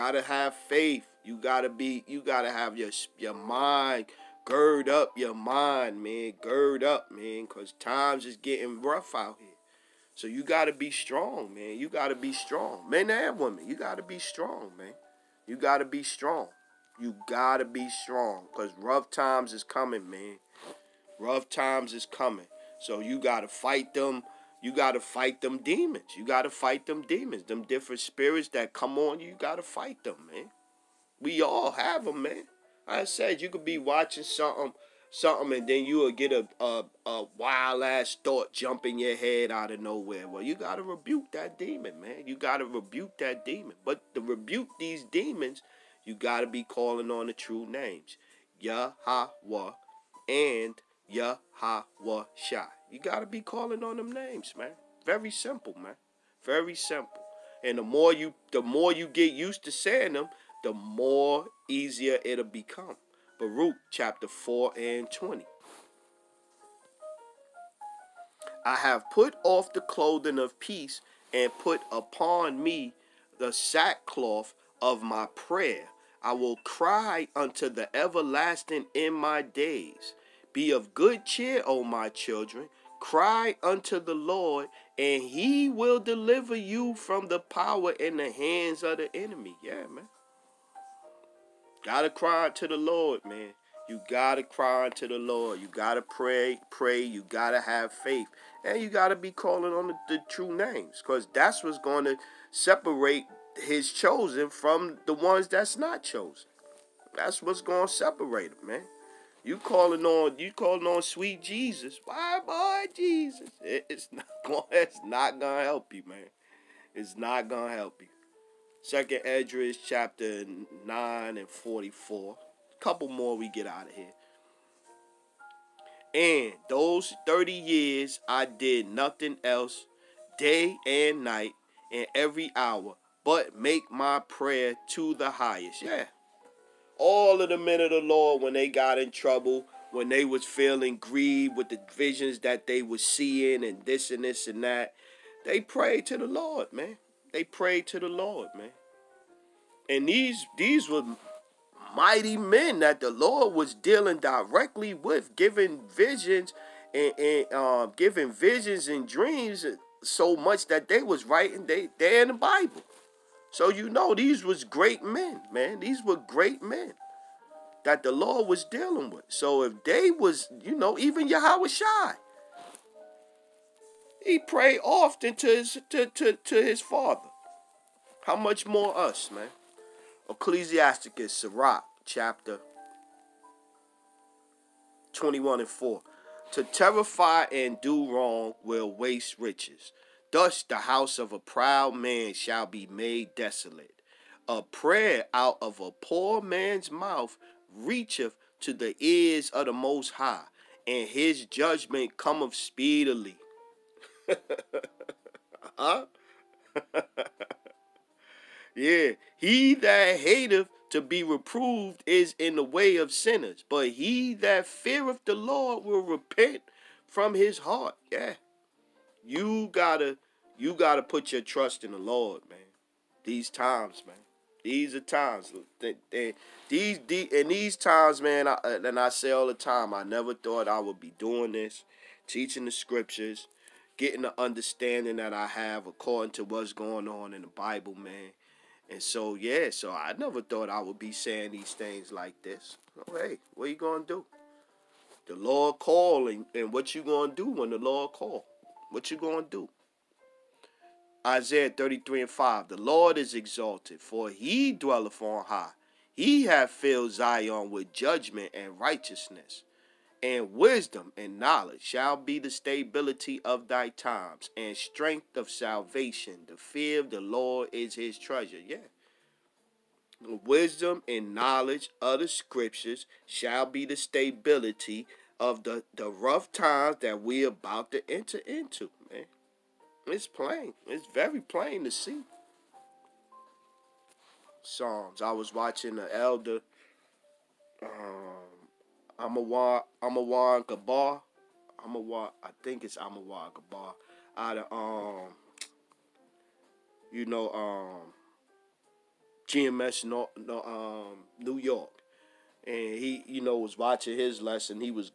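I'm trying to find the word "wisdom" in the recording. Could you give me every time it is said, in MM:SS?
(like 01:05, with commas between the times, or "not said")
04:20, 04:30.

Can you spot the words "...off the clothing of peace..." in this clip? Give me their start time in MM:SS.
01:09.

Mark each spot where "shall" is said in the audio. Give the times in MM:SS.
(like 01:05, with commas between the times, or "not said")
03:12, 04:21, 04:33.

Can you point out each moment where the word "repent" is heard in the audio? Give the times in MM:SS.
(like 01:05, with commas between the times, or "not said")
03:36.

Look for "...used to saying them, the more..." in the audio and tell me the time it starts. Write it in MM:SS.
00:59.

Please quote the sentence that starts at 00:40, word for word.
Well, you gotta rebuke that demon, man.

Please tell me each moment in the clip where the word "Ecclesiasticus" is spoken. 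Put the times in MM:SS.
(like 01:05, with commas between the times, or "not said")
03:00.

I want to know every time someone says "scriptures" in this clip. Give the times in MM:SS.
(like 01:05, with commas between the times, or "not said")
03:52, 04:32.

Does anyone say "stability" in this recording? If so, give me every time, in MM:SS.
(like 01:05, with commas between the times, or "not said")
04:22, 04:33.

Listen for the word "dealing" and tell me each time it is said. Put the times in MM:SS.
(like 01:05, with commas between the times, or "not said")
02:33, 02:48.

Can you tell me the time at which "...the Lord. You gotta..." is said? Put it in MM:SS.
01:35.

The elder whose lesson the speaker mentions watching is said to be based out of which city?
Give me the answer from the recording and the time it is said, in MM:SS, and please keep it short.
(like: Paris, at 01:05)
New York, at 05:01.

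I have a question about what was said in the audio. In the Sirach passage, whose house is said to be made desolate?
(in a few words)
a proud man.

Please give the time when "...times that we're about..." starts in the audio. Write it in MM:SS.
04:36.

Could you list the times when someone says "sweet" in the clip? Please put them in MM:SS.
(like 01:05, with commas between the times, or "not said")
01:51.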